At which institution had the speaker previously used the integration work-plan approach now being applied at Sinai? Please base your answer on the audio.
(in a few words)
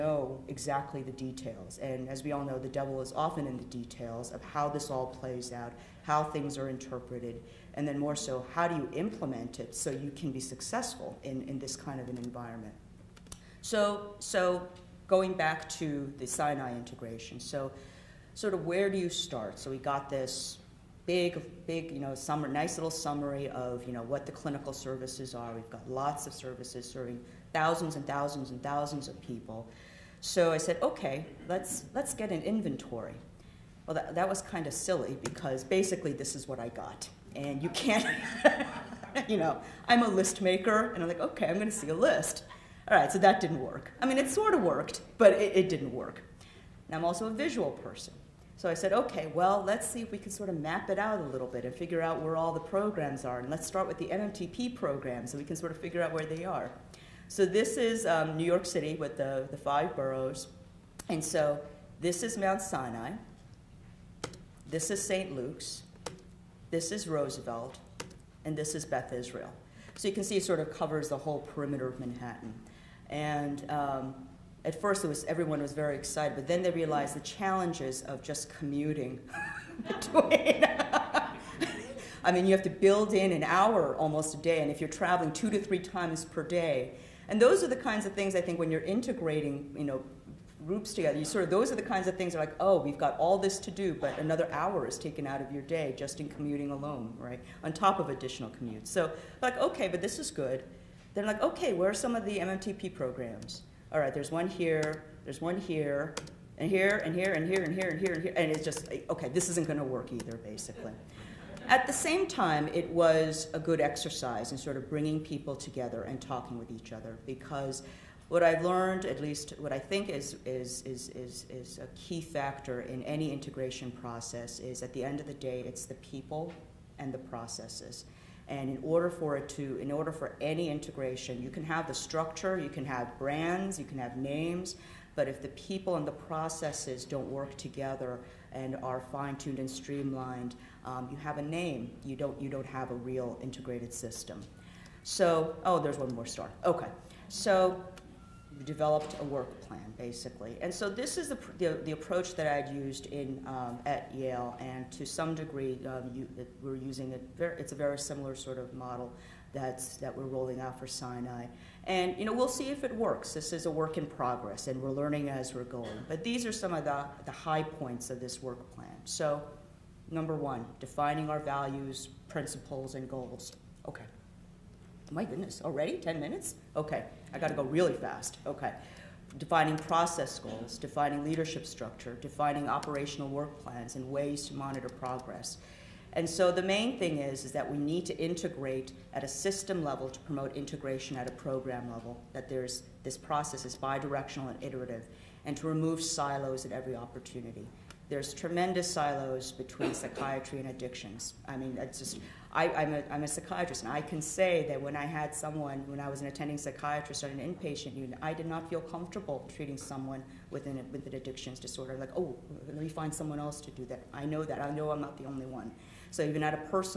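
Yale.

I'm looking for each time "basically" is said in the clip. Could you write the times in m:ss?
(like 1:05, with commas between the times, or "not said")
0:35, 1:50, 2:29.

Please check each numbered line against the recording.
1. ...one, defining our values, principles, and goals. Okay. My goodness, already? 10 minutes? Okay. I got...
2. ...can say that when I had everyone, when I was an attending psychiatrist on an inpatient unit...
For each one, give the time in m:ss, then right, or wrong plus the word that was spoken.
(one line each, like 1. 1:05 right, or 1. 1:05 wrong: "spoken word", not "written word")
1. 2:50 right
2. 3:24 wrong: "someone", not "everyone".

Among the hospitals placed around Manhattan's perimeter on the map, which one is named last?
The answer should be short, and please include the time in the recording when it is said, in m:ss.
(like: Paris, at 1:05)
Beth Israel, at 1:08.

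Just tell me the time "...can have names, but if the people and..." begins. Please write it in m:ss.
2:13.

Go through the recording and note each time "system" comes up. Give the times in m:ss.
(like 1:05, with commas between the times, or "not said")
2:23, 3:09.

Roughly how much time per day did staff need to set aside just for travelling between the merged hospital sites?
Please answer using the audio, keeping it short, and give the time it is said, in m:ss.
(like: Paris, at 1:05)
an hour, at 1:23.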